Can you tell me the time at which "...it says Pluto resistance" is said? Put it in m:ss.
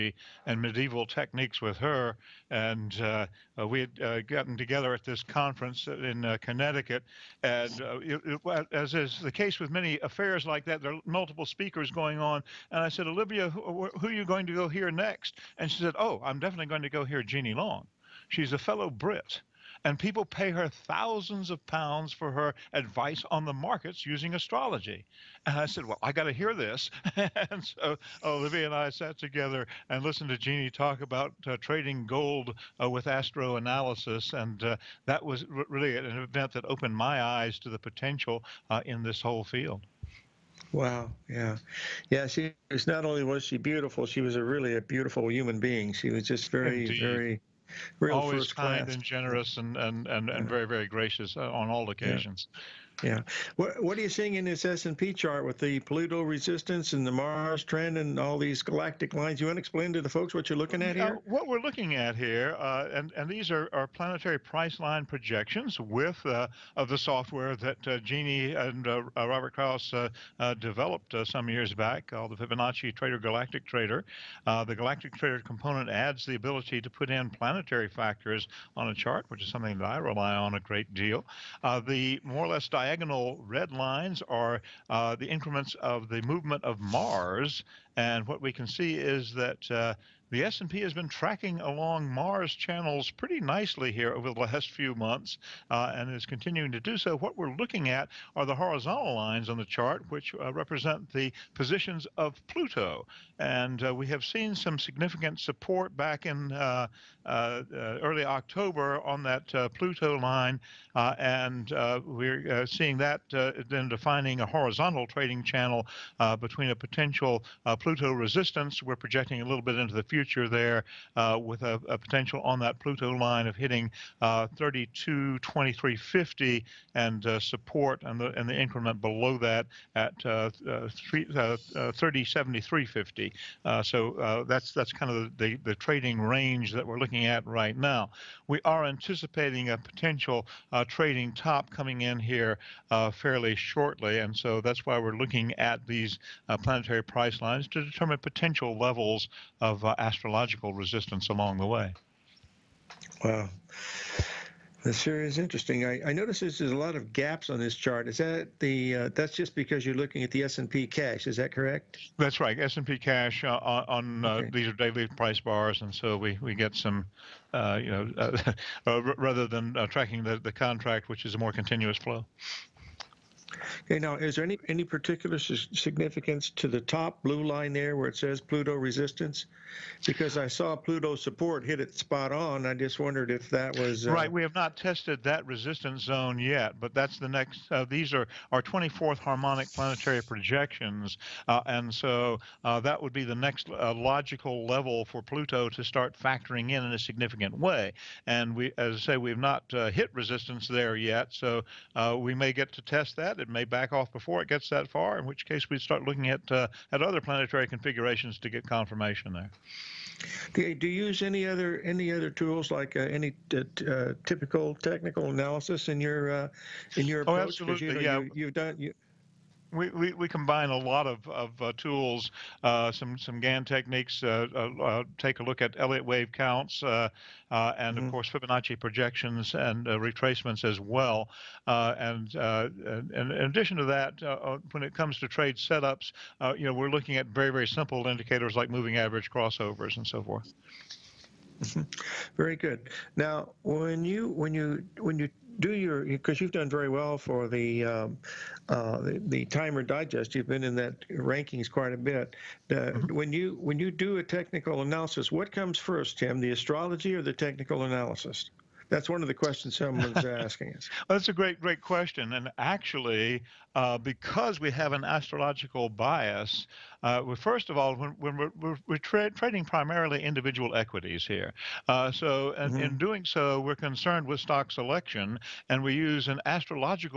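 2:58.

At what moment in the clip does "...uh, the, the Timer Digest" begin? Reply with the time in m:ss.
4:08.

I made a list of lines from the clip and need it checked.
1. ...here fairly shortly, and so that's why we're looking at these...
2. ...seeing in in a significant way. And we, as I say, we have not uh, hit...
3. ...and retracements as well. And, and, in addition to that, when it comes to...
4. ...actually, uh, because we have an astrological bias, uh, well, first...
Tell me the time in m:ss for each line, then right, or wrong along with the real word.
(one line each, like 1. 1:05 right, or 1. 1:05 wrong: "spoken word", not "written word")
1. 2:22 right
2. 3:16 wrong: "factoring", not "seeing"
3. 3:49 right
4. 4:22 right.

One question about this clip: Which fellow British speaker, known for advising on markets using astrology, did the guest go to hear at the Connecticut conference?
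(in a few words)
Jeannie Long.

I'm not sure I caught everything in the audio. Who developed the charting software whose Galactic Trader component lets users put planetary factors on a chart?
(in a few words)
Robert Krausz.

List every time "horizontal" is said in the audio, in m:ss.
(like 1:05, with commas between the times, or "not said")
1:38, 1:54.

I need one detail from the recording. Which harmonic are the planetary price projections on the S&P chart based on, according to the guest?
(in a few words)
24th harmonic.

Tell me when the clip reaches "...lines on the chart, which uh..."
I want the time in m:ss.
1:39.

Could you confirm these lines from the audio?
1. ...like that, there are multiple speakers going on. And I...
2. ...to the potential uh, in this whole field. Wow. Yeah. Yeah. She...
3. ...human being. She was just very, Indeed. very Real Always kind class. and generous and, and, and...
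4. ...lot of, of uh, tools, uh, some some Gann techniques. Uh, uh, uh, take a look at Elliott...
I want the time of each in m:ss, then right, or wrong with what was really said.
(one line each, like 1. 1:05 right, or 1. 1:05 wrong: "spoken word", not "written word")
1. 0:10 right
2. 0:37 right
3. 0:45 right
4. 3:40 right.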